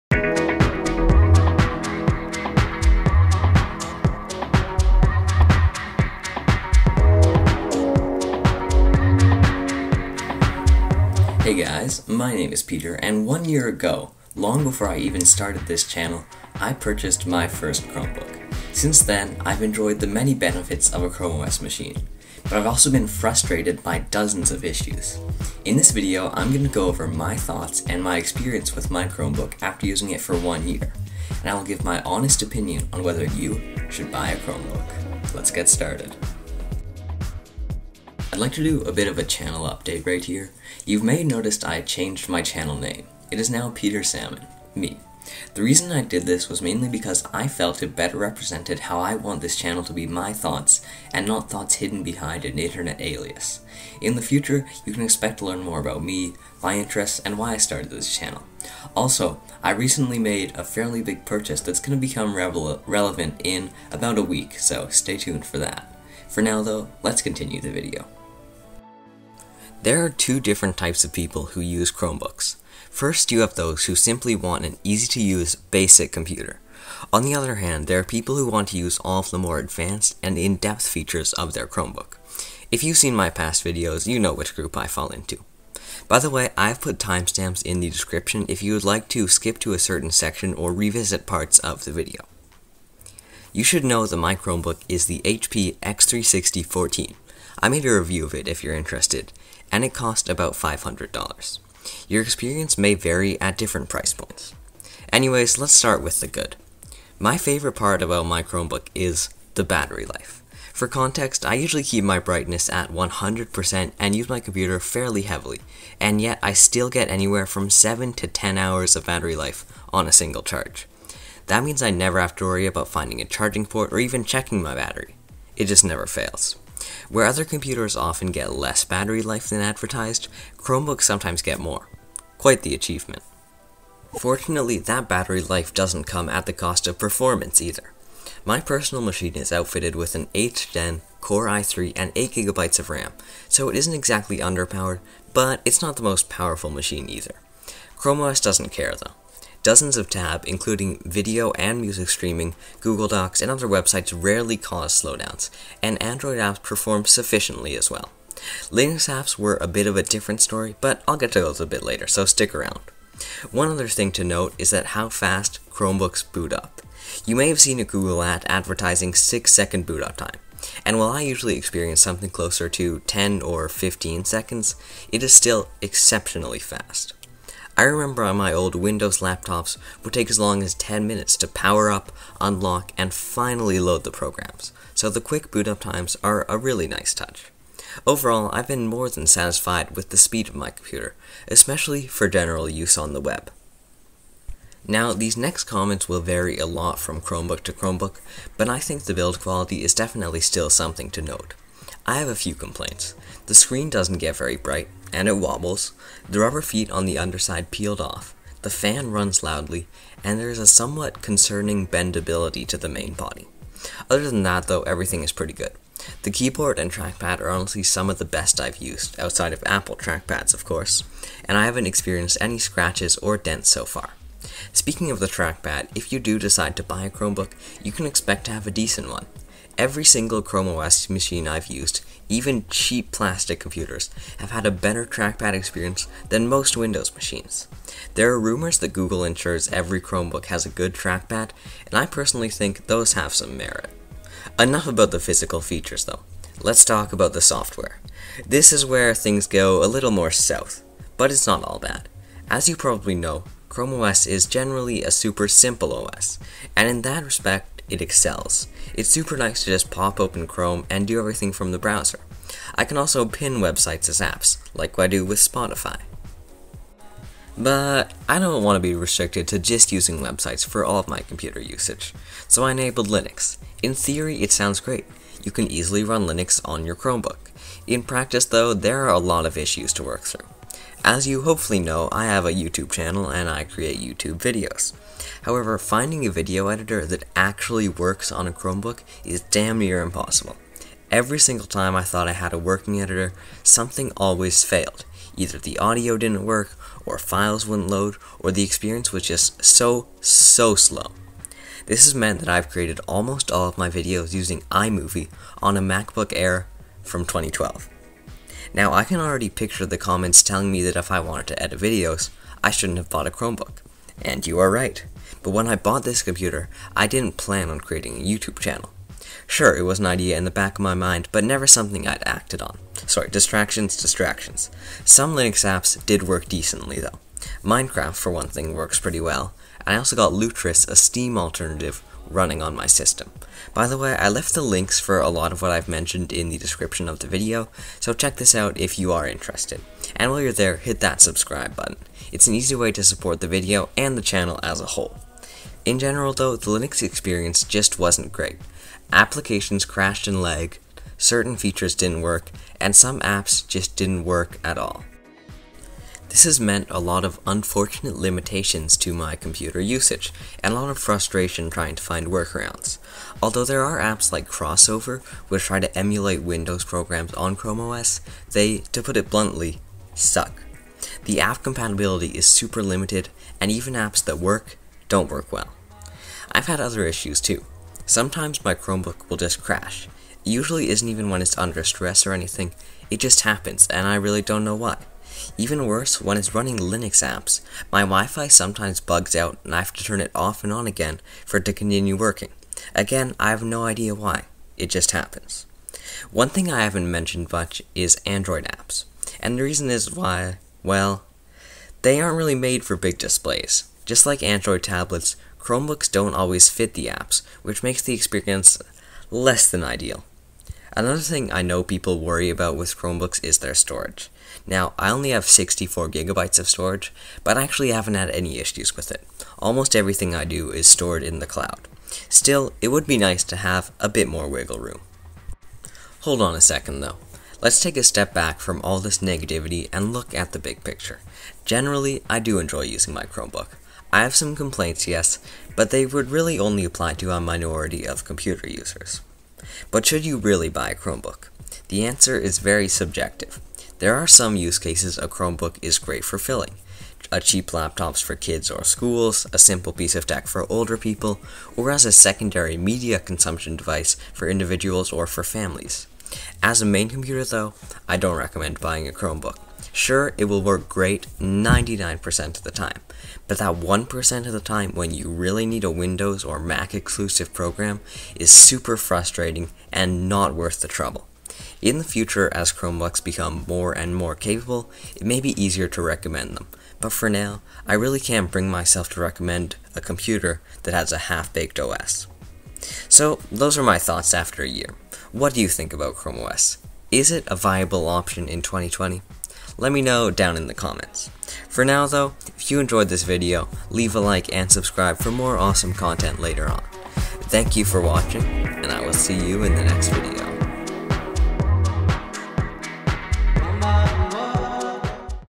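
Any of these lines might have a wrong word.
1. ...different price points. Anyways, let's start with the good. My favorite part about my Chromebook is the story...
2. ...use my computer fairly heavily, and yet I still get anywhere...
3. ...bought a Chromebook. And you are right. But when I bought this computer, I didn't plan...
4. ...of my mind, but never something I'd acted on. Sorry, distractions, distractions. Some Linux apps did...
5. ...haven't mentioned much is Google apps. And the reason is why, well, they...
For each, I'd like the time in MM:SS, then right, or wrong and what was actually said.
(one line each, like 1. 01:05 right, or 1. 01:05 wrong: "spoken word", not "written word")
1. 01:43 wrong: "battery", not "story"
2. 01:54 right
3. 05:13 right
4. 05:20 right
5. 06:36 wrong: "Android", not "Google".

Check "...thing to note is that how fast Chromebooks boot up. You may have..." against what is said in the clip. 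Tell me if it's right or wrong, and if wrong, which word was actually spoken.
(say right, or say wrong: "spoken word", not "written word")
right.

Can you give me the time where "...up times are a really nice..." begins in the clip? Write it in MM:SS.
03:05.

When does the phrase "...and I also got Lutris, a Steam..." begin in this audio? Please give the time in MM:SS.
05:29.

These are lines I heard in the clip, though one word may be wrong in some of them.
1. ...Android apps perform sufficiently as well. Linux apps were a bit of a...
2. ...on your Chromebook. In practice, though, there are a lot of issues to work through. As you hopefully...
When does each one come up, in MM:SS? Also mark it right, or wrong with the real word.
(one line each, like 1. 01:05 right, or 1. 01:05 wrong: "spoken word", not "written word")
1. 02:36 right
2. 04:36 right.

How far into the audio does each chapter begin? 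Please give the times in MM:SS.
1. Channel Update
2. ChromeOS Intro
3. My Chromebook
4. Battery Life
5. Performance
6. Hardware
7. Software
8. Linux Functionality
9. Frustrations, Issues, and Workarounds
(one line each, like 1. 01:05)
1. 00:37
2. 01:09
3. 01:33
4. 01:48
5. 02:14
6. 03:16
7. 04:07
8. 04:27
9. 06:00.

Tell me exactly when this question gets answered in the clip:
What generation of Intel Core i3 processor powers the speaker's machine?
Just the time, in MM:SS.
02:20.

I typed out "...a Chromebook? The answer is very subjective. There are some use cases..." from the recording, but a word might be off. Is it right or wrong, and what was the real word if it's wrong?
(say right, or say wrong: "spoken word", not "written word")
right.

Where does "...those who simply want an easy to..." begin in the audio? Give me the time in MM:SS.
01:13.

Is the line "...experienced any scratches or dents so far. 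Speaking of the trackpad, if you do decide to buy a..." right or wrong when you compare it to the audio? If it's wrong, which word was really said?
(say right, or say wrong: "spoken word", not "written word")
right.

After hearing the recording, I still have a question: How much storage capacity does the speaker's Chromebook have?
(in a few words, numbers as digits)
64 gigabytes.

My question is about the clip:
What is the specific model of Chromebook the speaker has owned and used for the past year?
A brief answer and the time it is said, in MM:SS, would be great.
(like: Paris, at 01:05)
HP X360 14, at 01:35.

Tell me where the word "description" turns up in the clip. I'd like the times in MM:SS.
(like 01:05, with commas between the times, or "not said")
01:27, 05:36.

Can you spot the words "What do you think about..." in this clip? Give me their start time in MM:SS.
08:05.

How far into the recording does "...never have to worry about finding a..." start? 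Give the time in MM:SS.
02:01.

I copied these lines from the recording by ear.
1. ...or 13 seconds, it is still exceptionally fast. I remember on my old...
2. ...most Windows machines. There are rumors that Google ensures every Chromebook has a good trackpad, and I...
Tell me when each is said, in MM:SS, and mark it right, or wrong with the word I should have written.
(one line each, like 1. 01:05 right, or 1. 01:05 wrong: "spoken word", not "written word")
1. 02:53 wrong: "15", not "13"
2. 03:56 right.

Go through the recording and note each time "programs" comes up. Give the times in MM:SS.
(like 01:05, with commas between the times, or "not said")
03:04, 06:06, 07:47.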